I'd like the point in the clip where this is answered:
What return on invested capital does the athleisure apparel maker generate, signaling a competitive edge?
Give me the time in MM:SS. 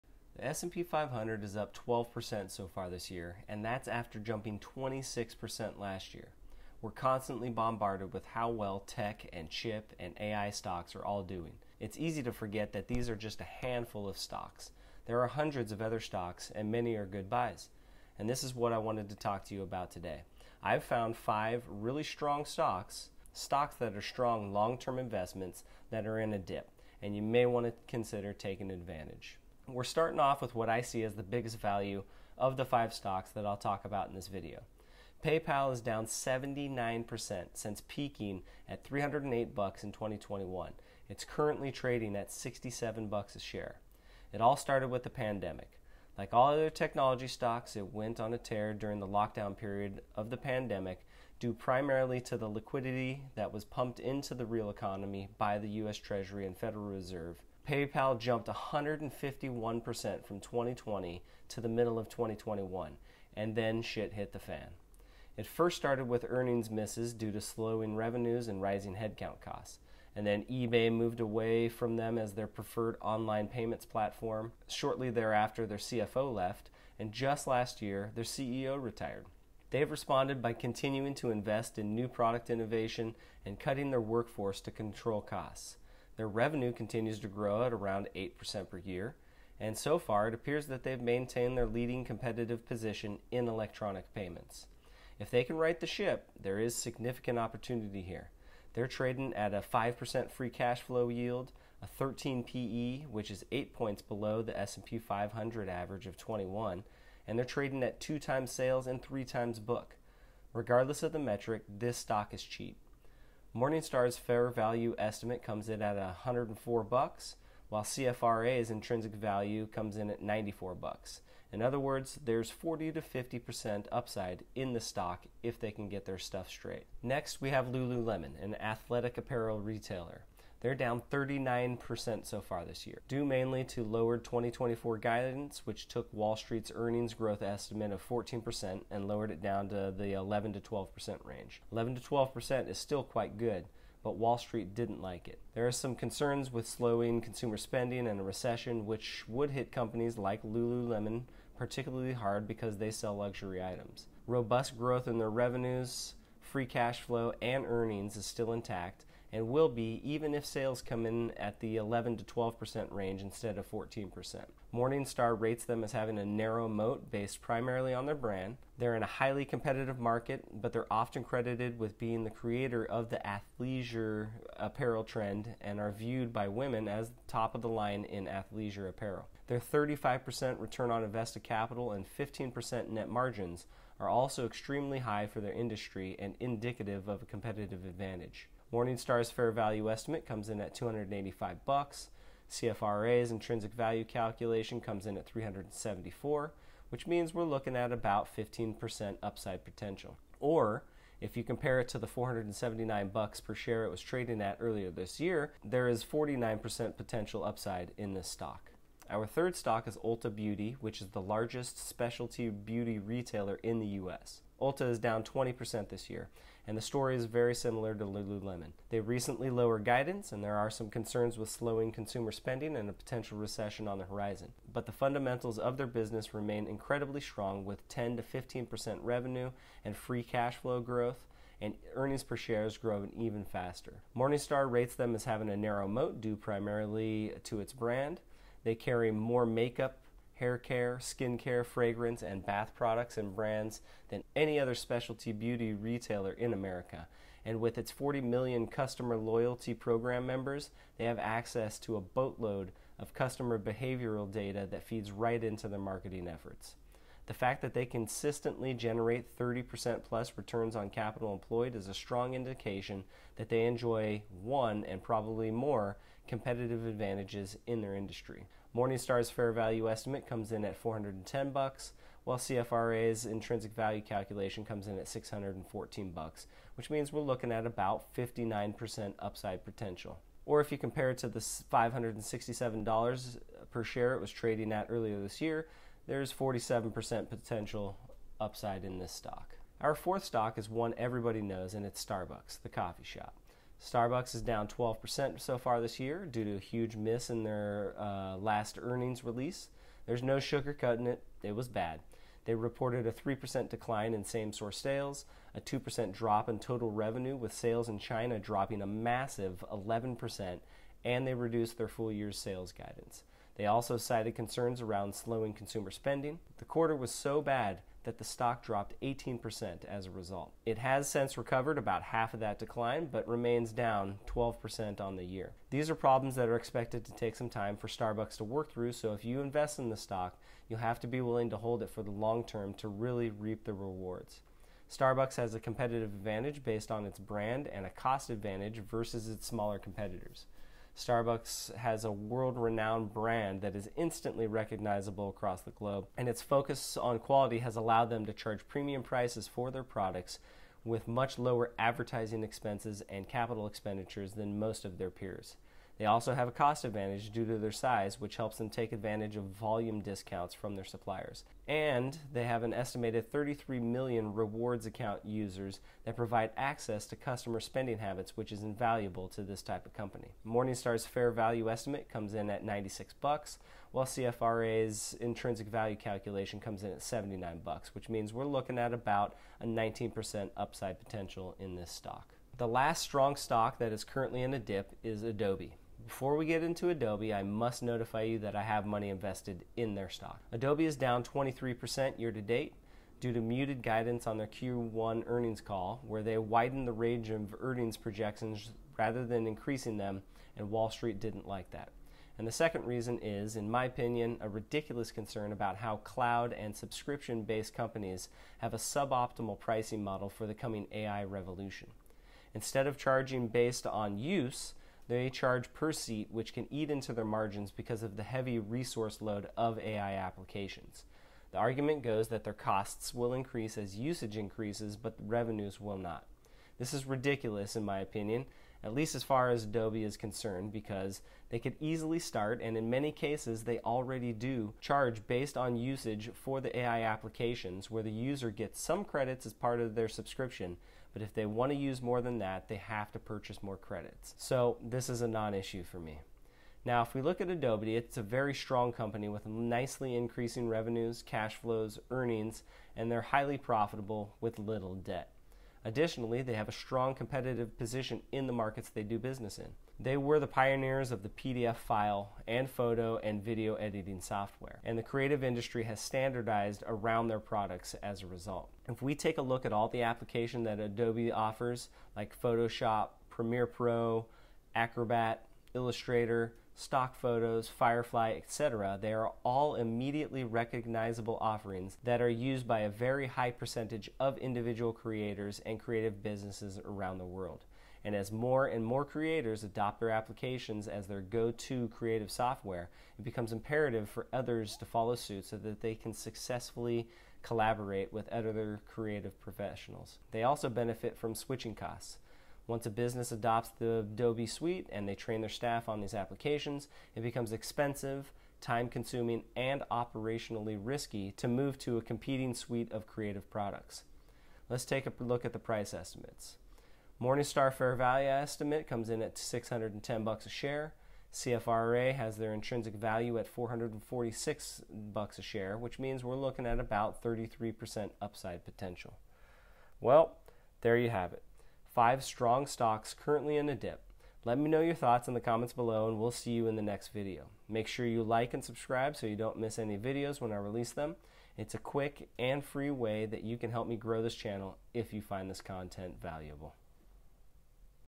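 02:59.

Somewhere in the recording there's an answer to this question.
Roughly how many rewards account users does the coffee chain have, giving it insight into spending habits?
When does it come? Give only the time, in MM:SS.
06:03.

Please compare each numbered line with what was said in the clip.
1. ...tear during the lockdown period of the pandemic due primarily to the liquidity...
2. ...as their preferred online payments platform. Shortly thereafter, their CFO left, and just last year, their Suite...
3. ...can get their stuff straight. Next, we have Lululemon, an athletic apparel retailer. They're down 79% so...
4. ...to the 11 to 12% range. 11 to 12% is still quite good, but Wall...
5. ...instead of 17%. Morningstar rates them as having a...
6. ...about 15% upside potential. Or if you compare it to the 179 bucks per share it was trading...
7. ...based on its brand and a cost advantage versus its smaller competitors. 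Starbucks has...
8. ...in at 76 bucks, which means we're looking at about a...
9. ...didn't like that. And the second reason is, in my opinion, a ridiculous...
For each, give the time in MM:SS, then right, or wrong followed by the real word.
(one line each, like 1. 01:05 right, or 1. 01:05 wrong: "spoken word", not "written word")
1. 00:48 right
2. 01:12 wrong: "CEO", not "Suite"
3. 02:05 wrong: "39", not "79"
4. 02:19 right
5. 02:43 wrong: "14", not "17"
6. 03:17 wrong: "479", not "179"
7. 05:36 right
8. 06:16 wrong: "79", not "76"
9. 06:41 right.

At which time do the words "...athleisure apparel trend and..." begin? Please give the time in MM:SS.
02:53.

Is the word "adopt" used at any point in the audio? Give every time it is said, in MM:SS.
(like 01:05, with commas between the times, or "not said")
08:09, 08:23.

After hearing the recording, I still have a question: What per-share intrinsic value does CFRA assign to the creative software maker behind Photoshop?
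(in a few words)
$446.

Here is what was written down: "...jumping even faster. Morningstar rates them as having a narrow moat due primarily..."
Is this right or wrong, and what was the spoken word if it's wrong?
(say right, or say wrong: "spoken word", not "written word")
wrong: "growing", not "jumping".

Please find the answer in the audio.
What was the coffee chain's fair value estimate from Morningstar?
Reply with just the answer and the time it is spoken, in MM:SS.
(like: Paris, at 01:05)
$96, at 06:12.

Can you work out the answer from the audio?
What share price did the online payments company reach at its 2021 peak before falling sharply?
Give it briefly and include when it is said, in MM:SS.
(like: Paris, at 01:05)
$308, at 00:38.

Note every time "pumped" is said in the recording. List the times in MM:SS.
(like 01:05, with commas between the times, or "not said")
00:53.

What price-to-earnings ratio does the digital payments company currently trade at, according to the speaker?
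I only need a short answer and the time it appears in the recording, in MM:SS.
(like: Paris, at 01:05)
13, at 01:41.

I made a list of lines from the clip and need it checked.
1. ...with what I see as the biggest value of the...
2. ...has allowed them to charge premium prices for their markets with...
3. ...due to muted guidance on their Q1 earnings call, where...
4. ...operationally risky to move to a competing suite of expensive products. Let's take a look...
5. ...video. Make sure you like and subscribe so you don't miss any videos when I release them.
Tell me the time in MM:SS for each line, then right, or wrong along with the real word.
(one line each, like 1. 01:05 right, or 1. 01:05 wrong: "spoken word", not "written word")
1. 00:30 right
2. 05:47 wrong: "products", not "markets"
3. 06:33 right
4. 08:29 wrong: "creative", not "expensive"
5. 08:57 right.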